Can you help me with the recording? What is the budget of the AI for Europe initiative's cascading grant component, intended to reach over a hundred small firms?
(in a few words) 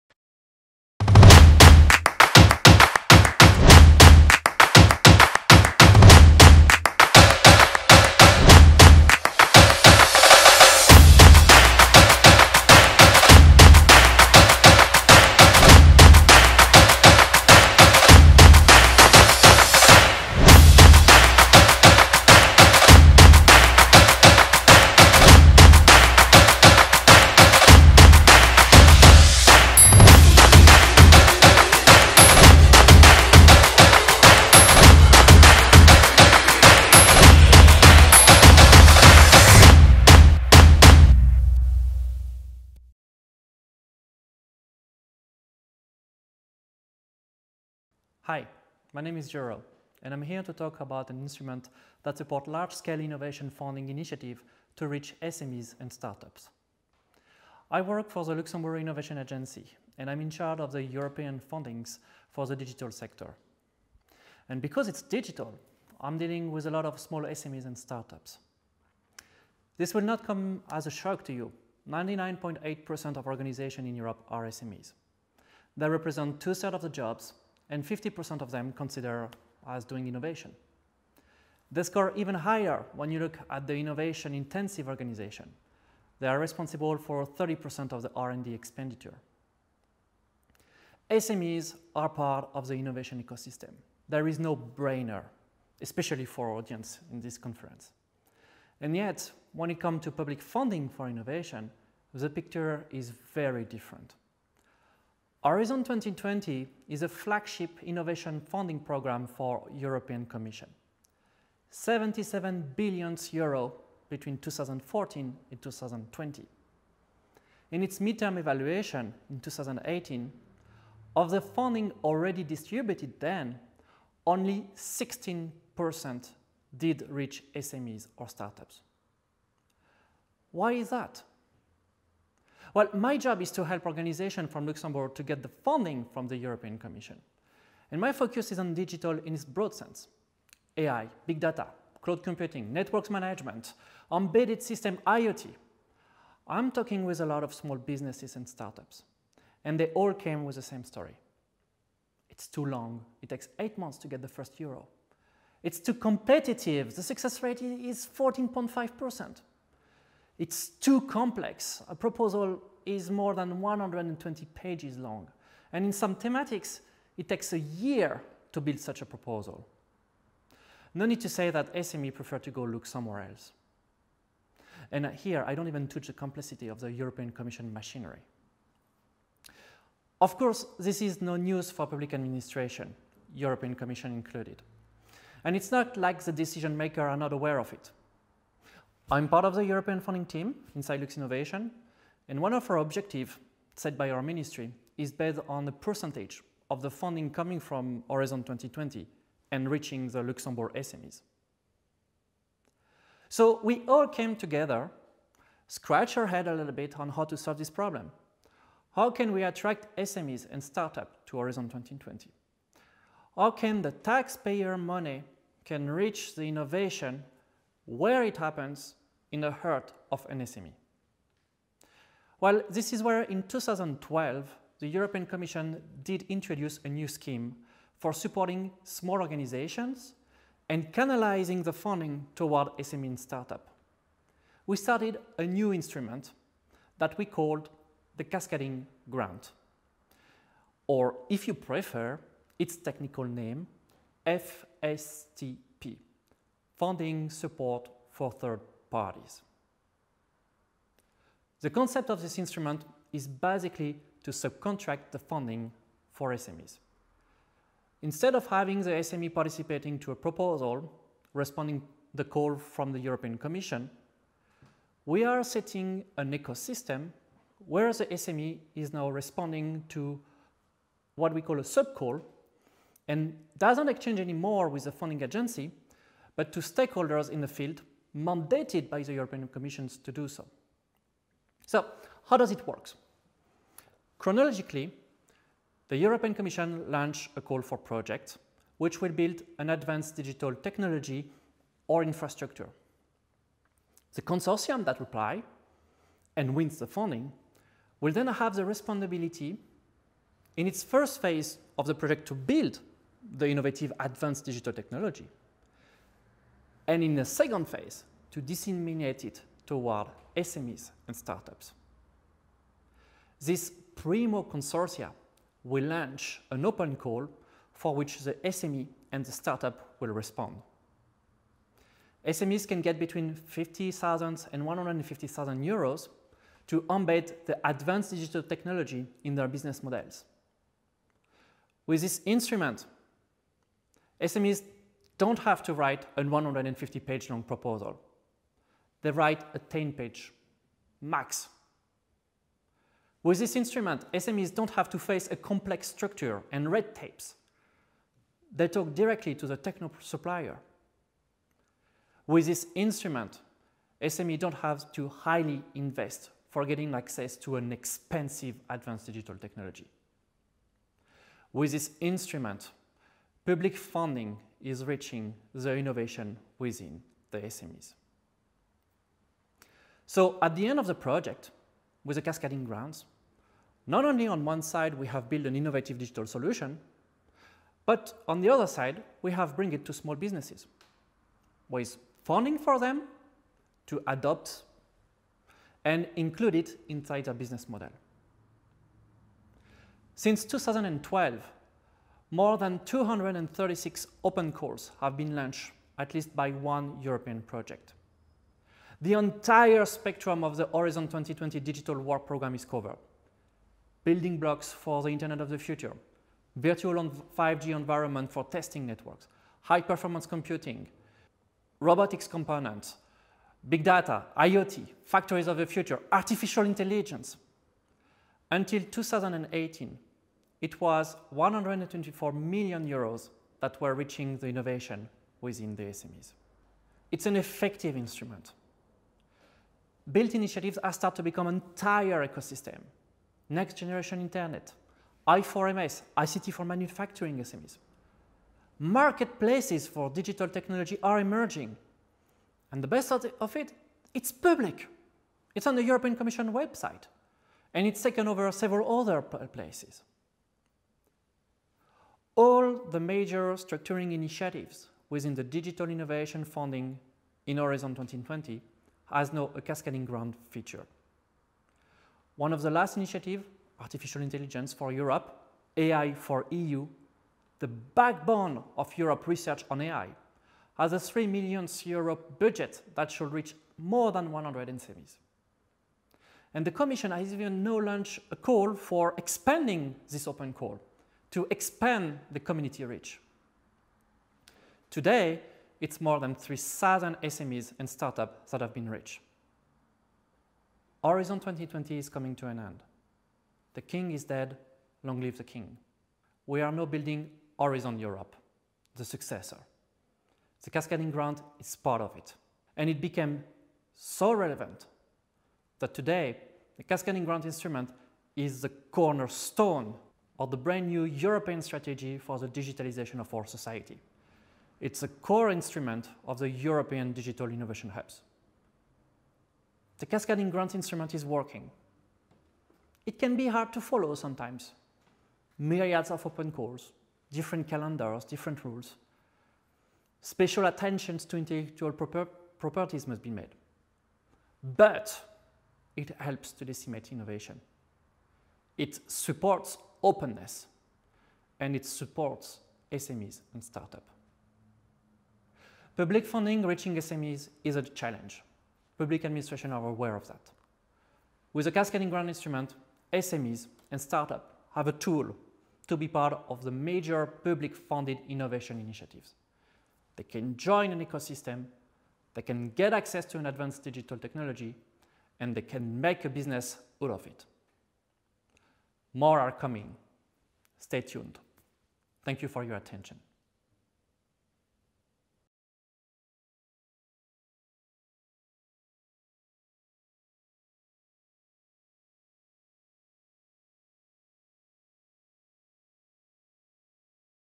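3 million euros.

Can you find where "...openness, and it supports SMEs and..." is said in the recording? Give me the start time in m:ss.
9:00.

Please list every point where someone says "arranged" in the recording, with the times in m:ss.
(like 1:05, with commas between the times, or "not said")
not said.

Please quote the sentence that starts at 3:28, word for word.
How can we attract SMEs and startups to Horizon 2020?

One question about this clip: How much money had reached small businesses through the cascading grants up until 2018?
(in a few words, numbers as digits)
124 million euros.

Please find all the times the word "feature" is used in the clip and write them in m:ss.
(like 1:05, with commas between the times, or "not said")
7:40.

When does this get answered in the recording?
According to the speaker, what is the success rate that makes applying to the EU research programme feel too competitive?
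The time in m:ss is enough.
2:38.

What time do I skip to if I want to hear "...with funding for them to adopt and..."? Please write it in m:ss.
6:21.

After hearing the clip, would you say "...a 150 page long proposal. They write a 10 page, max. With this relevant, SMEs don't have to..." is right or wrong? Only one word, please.
wrong.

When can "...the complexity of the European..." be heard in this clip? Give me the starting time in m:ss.
2:56.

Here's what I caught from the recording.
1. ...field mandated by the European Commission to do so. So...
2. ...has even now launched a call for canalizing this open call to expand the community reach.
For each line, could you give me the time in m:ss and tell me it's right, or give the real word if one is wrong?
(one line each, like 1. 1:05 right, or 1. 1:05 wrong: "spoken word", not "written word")
1. 4:37 right
2. 7:57 wrong: "expanding", not "canalizing".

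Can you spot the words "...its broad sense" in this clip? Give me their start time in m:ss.
2:19.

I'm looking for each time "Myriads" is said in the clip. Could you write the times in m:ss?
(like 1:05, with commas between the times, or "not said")
8:45.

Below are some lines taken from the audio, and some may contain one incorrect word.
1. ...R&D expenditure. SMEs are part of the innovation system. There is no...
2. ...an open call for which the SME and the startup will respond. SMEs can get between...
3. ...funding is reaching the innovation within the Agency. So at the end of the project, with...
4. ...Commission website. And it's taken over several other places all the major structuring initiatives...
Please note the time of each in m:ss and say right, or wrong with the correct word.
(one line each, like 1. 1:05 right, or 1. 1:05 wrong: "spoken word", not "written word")
1. 1:28 wrong: "ecosystem", not "system"
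2. 5:16 right
3. 6:03 wrong: "SMEs", not "Agency"
4. 7:26 right.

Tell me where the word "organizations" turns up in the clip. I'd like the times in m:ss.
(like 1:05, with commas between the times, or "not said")
1:13, 1:24, 2:13, 3:49.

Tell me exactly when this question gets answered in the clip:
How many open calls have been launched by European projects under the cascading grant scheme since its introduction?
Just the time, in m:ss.
6:32.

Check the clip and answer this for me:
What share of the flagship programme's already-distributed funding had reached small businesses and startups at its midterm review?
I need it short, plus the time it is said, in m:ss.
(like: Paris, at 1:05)
16%, at 2:04.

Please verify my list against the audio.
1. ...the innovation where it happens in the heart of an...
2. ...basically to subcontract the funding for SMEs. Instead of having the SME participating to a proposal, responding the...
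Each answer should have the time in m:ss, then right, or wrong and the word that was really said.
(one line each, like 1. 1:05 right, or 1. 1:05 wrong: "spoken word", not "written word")
1. 3:36 right
2. 4:13 right.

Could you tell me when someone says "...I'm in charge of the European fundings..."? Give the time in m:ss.
1:00.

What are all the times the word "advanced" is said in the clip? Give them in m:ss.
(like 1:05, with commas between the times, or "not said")
4:49, 5:03, 5:27, 5:58, 9:23.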